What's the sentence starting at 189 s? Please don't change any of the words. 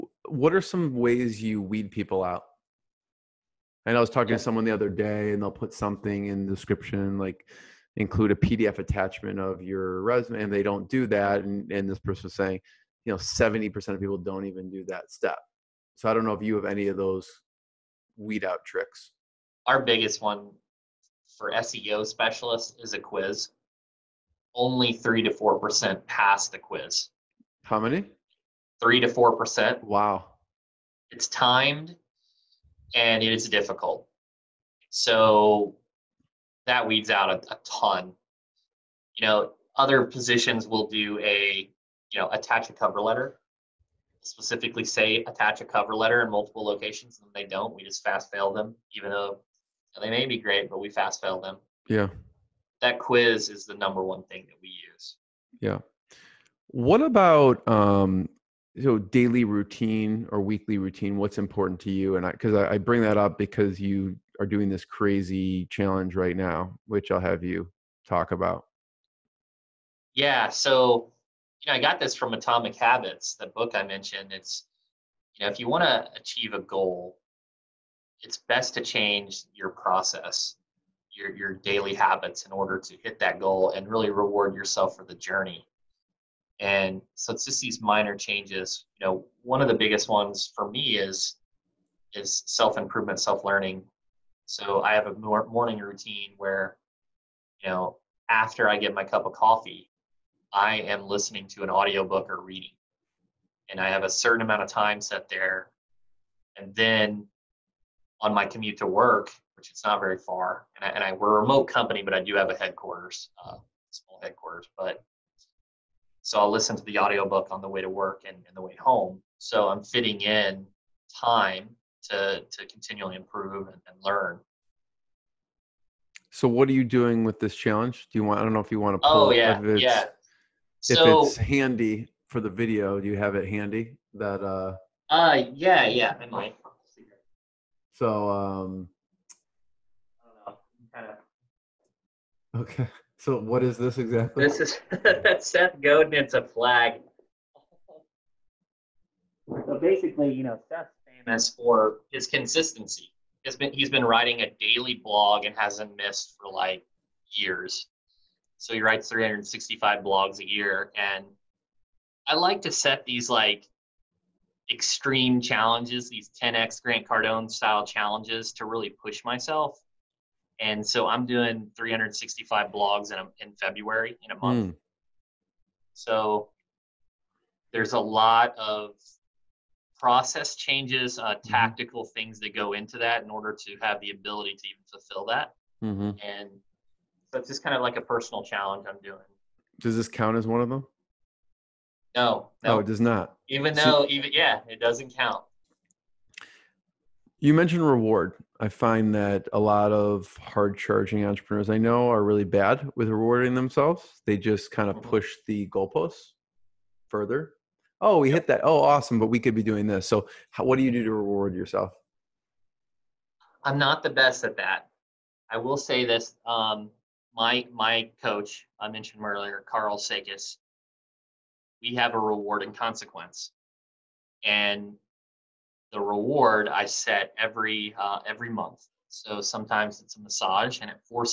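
Does this count as one of them?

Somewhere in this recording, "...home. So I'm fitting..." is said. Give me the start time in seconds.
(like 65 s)
118 s.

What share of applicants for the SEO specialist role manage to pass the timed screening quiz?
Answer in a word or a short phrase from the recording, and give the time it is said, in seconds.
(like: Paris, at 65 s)
3 to 4%, at 28 s.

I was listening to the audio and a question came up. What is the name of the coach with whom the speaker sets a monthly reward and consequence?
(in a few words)
Karl Sakas.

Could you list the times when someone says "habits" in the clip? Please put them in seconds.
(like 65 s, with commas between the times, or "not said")
72 s, 81 s.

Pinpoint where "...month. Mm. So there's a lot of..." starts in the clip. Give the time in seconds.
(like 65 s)
174 s.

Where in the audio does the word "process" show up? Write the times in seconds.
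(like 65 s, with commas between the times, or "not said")
79 s, 179 s.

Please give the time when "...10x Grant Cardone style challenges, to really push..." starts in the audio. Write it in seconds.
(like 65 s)
166 s.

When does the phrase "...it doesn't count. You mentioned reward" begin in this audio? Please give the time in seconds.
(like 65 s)
194 s.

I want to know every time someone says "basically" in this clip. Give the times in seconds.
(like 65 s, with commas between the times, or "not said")
149 s.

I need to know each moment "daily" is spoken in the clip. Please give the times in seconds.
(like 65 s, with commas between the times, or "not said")
58 s, 81 s, 154 s.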